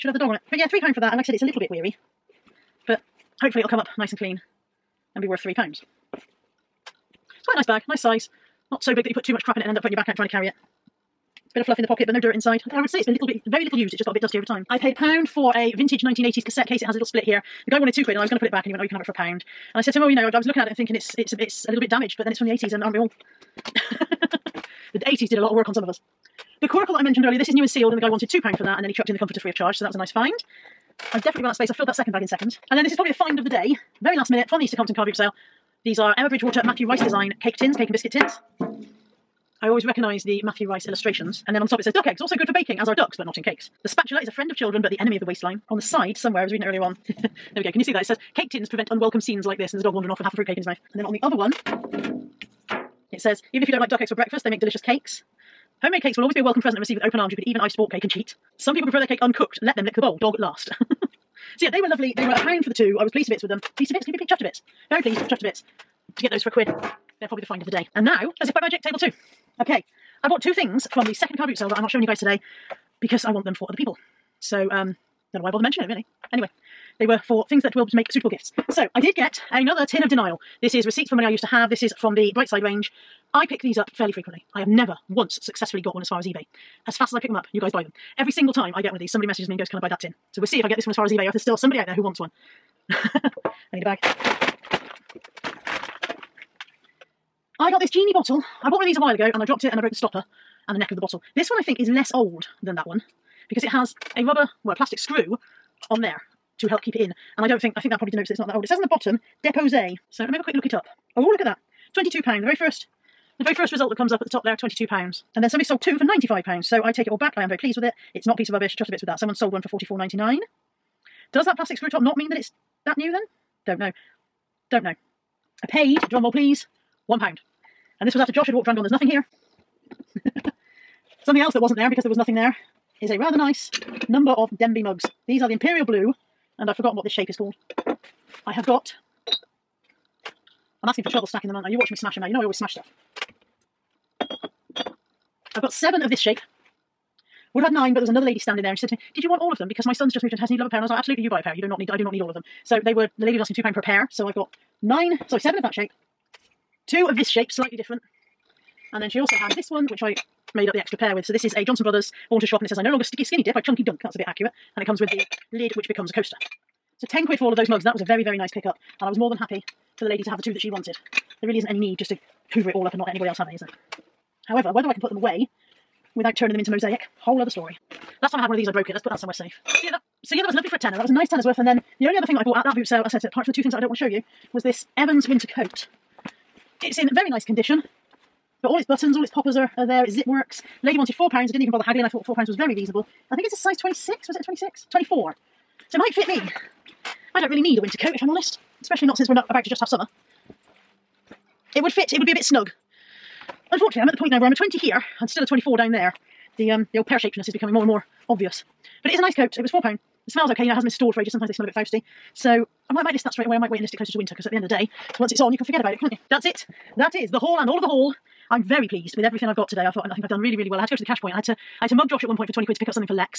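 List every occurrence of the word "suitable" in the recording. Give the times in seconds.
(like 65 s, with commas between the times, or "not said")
78 s.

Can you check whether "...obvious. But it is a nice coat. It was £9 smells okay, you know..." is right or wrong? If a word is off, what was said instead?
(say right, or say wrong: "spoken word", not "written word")
wrong: "4", not "9".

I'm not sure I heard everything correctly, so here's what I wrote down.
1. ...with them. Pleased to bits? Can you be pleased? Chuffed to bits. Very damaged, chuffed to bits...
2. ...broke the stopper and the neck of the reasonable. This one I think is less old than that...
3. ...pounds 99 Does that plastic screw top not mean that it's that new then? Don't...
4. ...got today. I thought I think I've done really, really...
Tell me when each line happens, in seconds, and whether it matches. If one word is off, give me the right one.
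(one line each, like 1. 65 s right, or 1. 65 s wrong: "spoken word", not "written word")
1. 63 s wrong: "pleased", not "damaged"
2. 99 s wrong: "bottle", not "reasonable"
3. 119 s right
4. 219 s right.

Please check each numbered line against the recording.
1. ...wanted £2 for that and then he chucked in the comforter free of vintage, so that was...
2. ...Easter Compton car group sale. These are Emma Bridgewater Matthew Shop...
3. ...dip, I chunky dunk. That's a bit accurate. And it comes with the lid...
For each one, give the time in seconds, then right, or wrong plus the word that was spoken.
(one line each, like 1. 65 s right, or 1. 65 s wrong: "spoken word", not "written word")
1. 28 s wrong: "charge", not "vintage"
2. 34 s wrong: "Rice", not "Shop"
3. 163 s right.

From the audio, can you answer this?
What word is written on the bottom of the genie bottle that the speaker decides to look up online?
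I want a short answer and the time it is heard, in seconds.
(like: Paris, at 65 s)
Deposé, at 109 s.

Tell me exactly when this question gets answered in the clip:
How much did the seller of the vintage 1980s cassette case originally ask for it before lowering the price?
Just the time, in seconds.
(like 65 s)
17 s.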